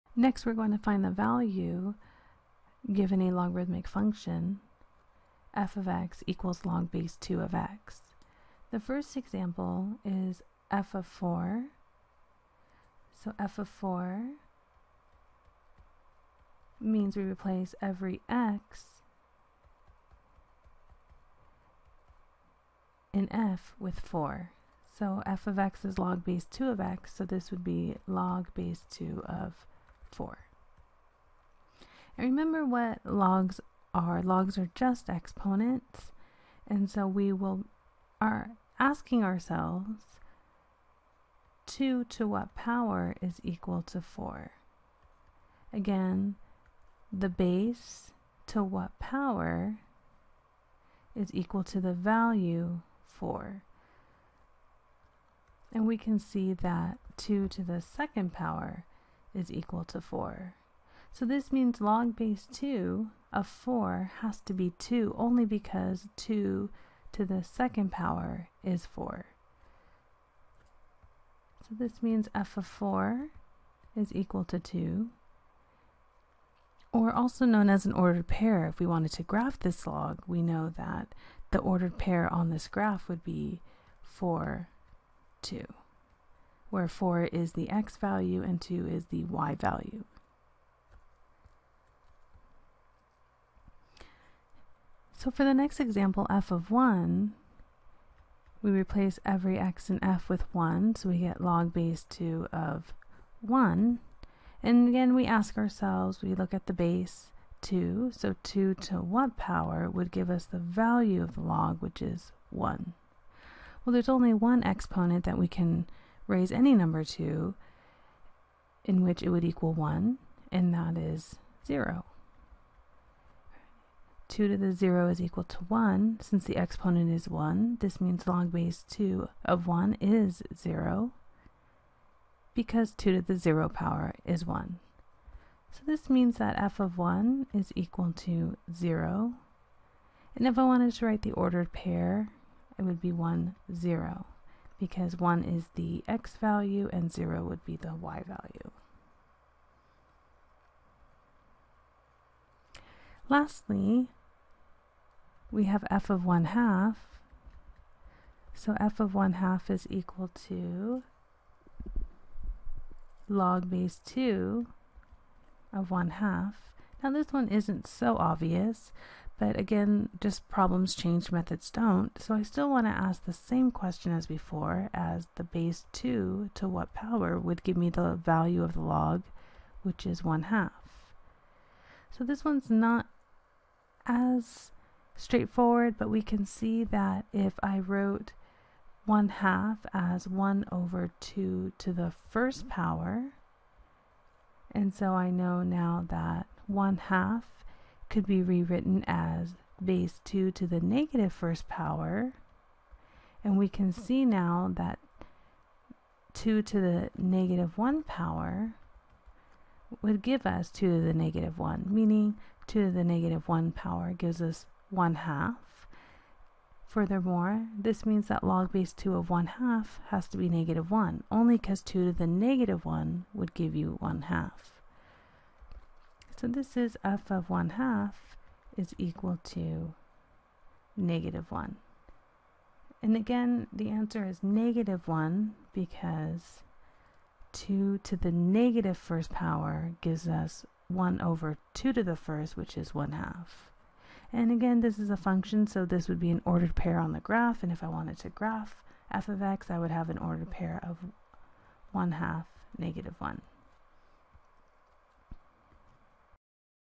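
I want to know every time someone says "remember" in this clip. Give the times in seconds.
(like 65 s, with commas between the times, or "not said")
32 s.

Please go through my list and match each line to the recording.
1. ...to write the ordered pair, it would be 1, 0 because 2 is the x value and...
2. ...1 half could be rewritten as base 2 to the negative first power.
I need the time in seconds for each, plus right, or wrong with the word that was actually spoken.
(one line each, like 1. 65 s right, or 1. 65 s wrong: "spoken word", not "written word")
1. 140 s wrong: "1", not "2"
2. 196 s right.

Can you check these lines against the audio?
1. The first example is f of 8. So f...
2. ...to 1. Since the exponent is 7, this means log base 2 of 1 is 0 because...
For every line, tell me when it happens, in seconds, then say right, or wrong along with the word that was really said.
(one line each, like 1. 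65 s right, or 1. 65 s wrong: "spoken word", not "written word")
1. 8 s wrong: "4", not "8"
2. 125 s wrong: "1", not "7".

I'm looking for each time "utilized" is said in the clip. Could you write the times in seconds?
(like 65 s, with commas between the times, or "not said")
not said.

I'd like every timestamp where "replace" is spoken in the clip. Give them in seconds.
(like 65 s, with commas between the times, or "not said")
17 s, 98 s.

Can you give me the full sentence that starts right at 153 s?
Lastly, we have f of 1 half.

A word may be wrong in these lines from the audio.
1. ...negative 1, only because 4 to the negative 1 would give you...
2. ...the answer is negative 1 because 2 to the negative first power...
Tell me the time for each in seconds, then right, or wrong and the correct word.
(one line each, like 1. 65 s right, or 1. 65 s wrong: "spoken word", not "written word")
1. 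220 s wrong: "2", not "4"
2. 233 s right.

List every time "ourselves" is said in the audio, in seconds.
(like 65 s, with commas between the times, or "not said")
39 s, 105 s.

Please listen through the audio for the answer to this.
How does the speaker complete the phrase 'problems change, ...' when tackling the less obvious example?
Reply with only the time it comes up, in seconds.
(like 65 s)
171 s.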